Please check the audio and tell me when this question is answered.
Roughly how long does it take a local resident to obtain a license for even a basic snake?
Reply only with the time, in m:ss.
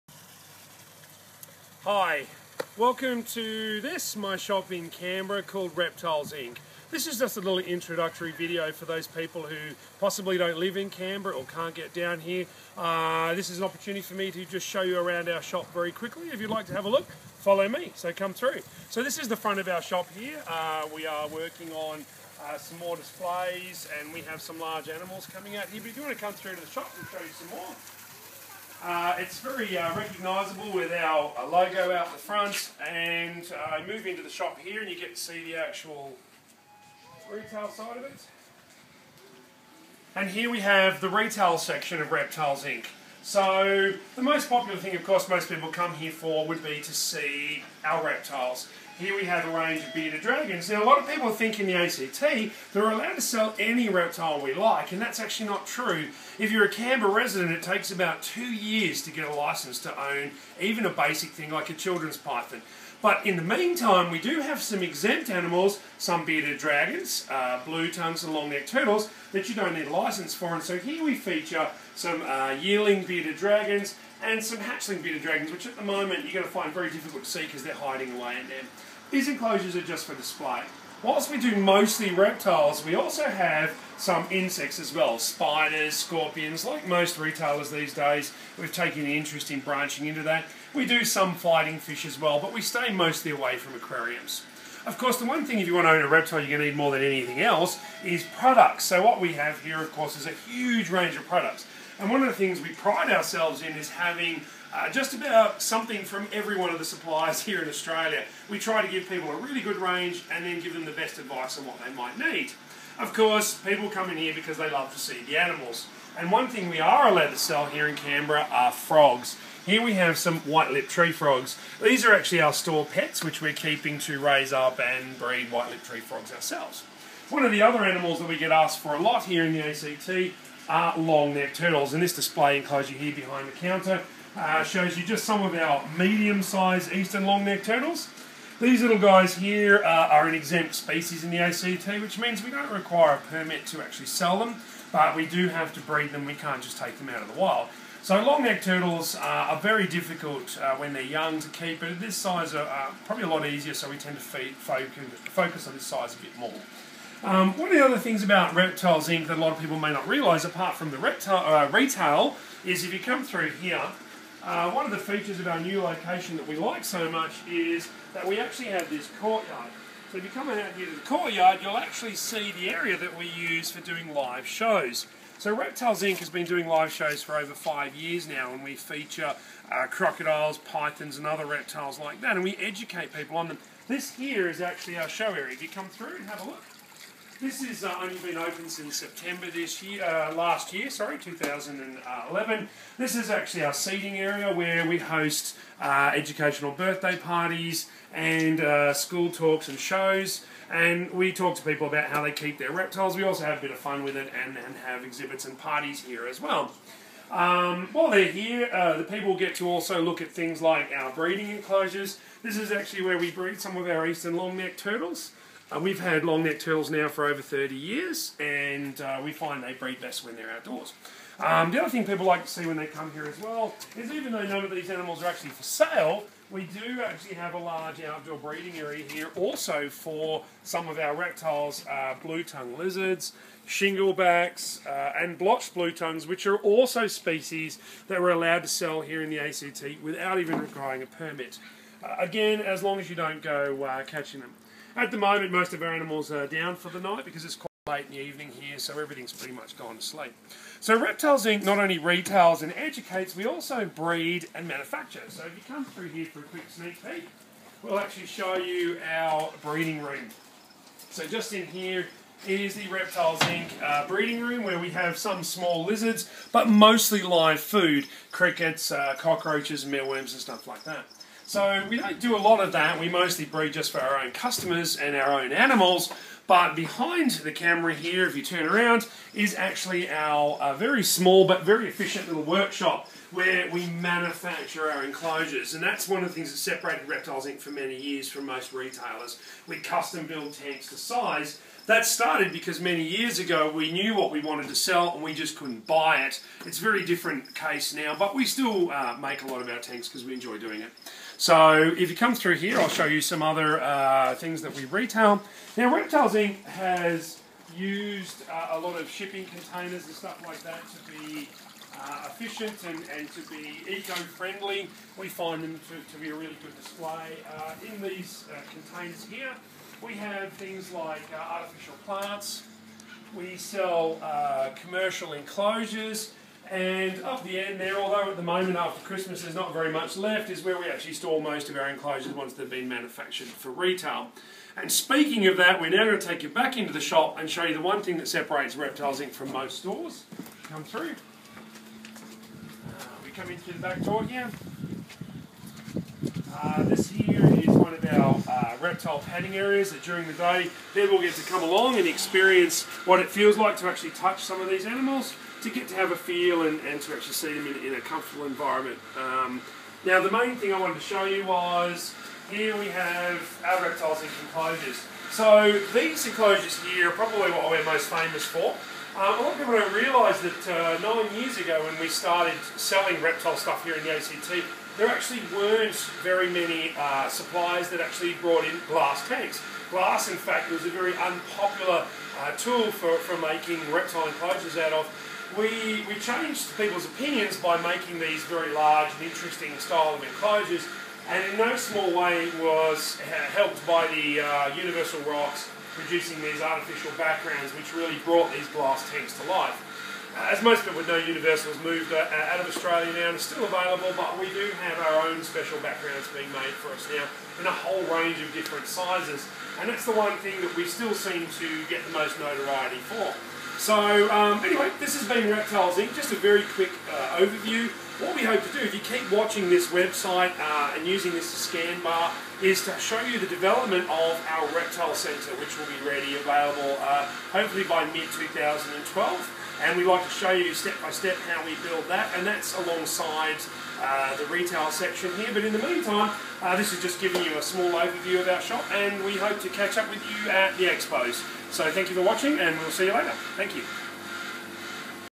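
0:57.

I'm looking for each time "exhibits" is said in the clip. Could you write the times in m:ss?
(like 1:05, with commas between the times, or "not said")
3:25.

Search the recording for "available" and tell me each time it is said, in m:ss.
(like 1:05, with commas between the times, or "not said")
6:43, 7:06.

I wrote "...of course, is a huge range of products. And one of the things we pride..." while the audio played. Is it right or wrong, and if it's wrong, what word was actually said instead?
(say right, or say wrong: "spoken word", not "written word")
right.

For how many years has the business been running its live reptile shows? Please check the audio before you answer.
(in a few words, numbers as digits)
Over 5 years.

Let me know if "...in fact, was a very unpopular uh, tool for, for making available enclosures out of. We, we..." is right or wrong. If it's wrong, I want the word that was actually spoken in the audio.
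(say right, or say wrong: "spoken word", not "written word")
wrong: "reptile", not "available".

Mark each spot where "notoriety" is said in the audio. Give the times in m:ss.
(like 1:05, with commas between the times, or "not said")
6:52.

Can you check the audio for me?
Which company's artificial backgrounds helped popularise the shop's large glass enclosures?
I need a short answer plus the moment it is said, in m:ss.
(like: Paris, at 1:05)
Universal Rocks, at 6:34.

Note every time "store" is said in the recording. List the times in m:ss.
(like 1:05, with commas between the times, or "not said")
2:02, 5:31, 5:39.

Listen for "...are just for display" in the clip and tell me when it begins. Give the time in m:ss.
1:19.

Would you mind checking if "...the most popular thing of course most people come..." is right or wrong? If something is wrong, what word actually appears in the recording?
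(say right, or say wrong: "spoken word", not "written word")
right.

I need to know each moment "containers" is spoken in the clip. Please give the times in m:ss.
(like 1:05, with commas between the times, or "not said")
5:09, 5:18.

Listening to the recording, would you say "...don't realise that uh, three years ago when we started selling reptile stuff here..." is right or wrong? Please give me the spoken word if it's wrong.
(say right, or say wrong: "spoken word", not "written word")
wrong: "nine", not "three".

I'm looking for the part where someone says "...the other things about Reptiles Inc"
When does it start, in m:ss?
2:37.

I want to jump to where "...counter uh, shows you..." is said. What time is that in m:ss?
2:13.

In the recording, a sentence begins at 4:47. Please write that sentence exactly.
for many years from most retailers.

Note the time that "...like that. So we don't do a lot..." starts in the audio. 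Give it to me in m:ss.
4:30.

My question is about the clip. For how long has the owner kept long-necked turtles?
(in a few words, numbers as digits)
Over 30 years.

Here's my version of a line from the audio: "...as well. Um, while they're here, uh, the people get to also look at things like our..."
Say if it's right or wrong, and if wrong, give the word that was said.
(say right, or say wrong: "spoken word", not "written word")
right.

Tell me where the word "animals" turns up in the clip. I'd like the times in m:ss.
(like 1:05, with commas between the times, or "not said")
0:24, 1:05, 1:55, 2:07, 3:44, 4:05, 4:35, 5:54.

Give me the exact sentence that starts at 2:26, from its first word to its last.
We can't just take them out of the wild.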